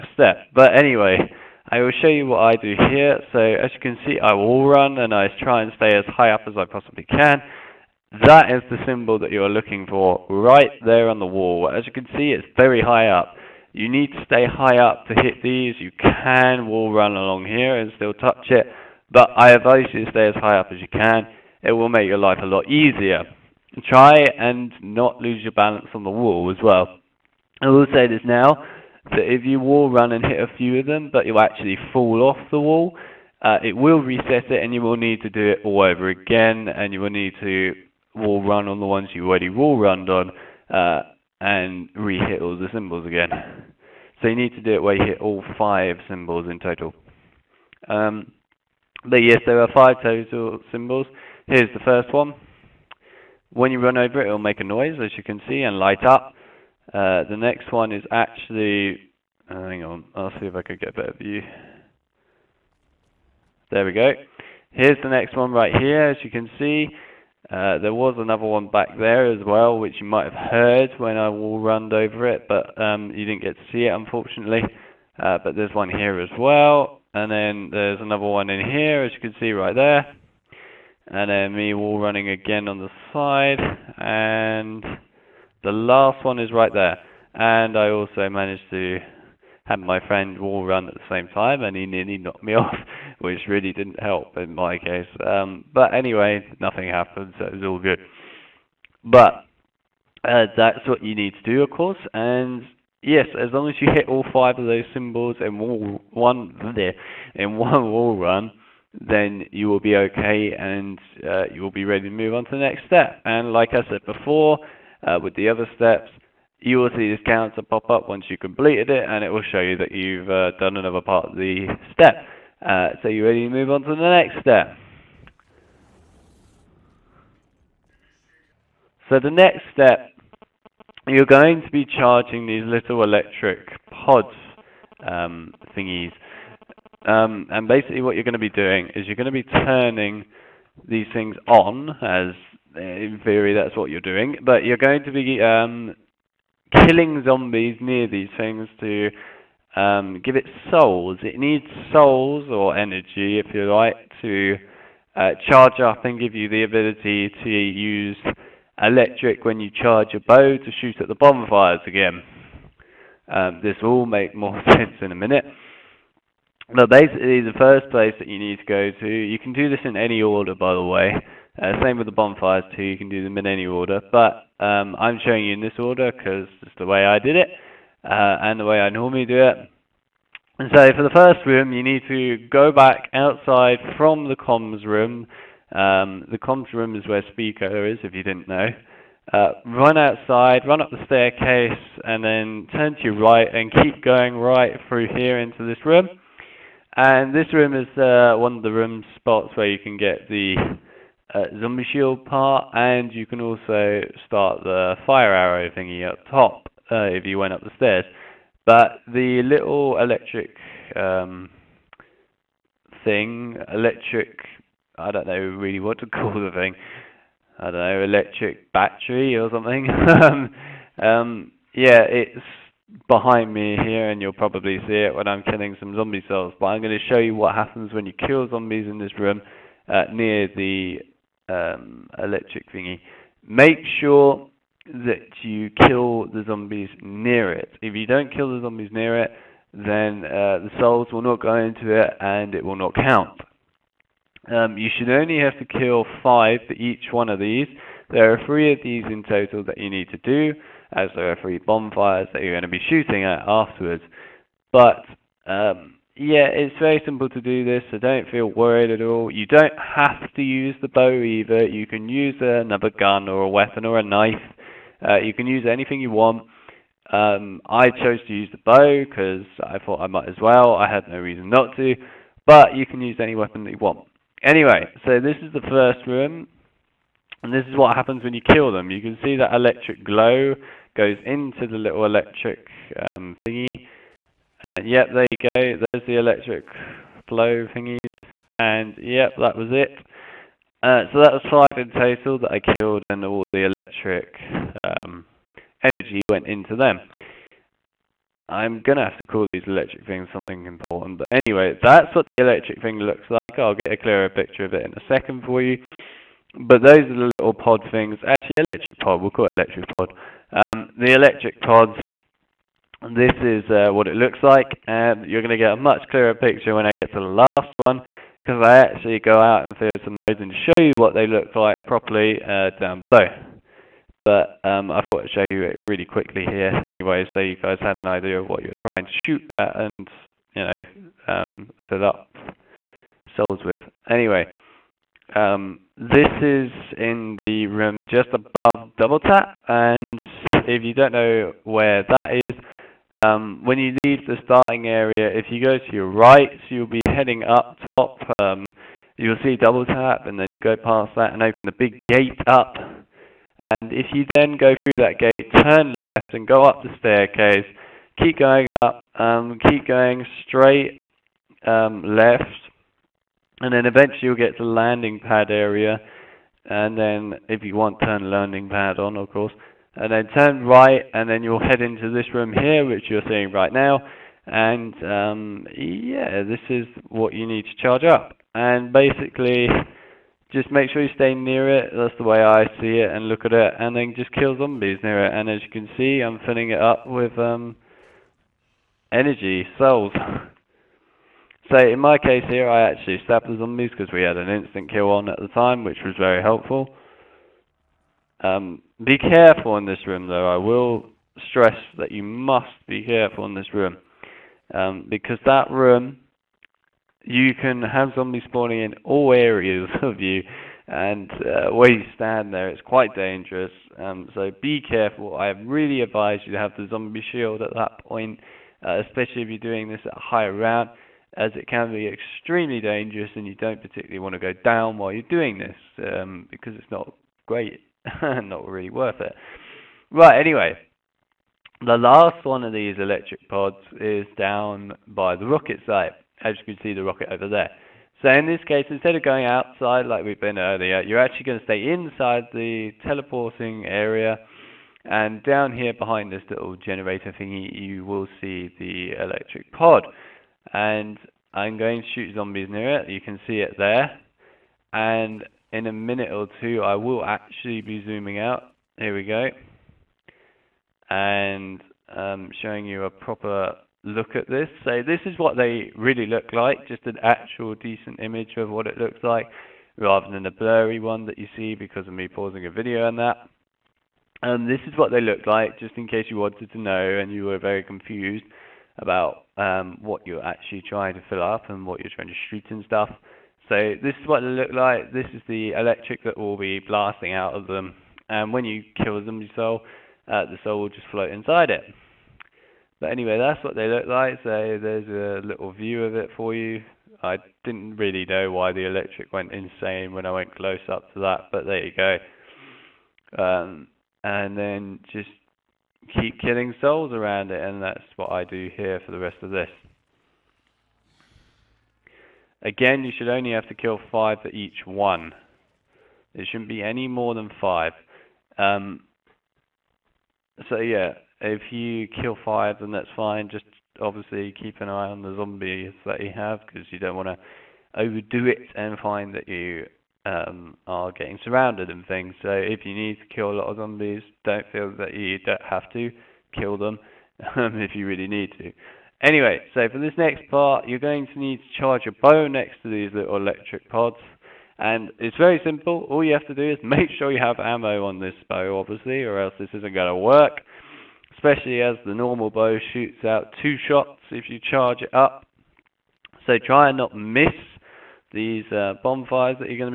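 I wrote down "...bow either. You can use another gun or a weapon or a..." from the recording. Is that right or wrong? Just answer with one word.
right.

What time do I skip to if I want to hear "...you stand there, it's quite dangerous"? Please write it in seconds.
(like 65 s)
411 s.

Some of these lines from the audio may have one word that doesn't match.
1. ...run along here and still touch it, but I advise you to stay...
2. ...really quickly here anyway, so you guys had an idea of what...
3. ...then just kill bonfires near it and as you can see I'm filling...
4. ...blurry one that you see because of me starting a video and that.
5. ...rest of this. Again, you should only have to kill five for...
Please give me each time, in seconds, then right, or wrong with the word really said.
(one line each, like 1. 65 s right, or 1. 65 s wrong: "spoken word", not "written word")
1. 16 s right
2. 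325 s right
3. 383 s wrong: "zombies", not "bonfires"
4. 470 s wrong: "pausing", not "starting"
5. 509 s right.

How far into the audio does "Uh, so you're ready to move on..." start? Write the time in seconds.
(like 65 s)
122 s.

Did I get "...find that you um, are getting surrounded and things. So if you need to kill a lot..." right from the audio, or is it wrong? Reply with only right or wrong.
right.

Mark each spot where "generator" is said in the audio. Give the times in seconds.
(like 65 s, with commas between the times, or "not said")
446 s.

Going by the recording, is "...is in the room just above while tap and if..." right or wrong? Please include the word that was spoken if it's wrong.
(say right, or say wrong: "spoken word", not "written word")
wrong: "double", not "while".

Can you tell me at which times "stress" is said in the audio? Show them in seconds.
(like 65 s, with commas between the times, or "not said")
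401 s.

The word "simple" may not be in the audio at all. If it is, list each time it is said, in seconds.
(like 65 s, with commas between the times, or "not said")
257 s, 545 s.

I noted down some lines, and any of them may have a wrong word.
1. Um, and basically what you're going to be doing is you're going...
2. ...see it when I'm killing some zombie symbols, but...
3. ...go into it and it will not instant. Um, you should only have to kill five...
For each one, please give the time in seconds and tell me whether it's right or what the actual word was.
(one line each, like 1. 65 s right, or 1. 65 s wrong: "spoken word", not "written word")
1. 137 s right
2. 224 s wrong: "cells", not "symbols"
3. 241 s wrong: "count", not "instant".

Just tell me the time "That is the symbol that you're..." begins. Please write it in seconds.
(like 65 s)
8 s.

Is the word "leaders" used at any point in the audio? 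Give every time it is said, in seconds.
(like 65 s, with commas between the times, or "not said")
not said.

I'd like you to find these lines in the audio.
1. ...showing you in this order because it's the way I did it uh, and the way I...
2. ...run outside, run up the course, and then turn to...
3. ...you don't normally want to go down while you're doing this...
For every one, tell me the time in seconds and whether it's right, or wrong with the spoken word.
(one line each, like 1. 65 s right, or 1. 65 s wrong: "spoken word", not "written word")
1. 175 s right
2. 189 s wrong: "staircase", not "course"
3. 423 s wrong: "particularly", not "normally".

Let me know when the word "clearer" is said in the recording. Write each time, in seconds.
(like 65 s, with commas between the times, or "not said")
303 s, 316 s.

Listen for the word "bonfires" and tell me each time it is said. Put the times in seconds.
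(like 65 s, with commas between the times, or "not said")
161 s, 172 s, 251 s, 559 s.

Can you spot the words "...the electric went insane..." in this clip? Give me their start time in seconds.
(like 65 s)
498 s.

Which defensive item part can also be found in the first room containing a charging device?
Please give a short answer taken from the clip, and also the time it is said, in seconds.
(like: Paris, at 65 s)
Zombie shield part, at 201 s.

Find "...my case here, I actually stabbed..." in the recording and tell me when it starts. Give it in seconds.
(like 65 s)
391 s.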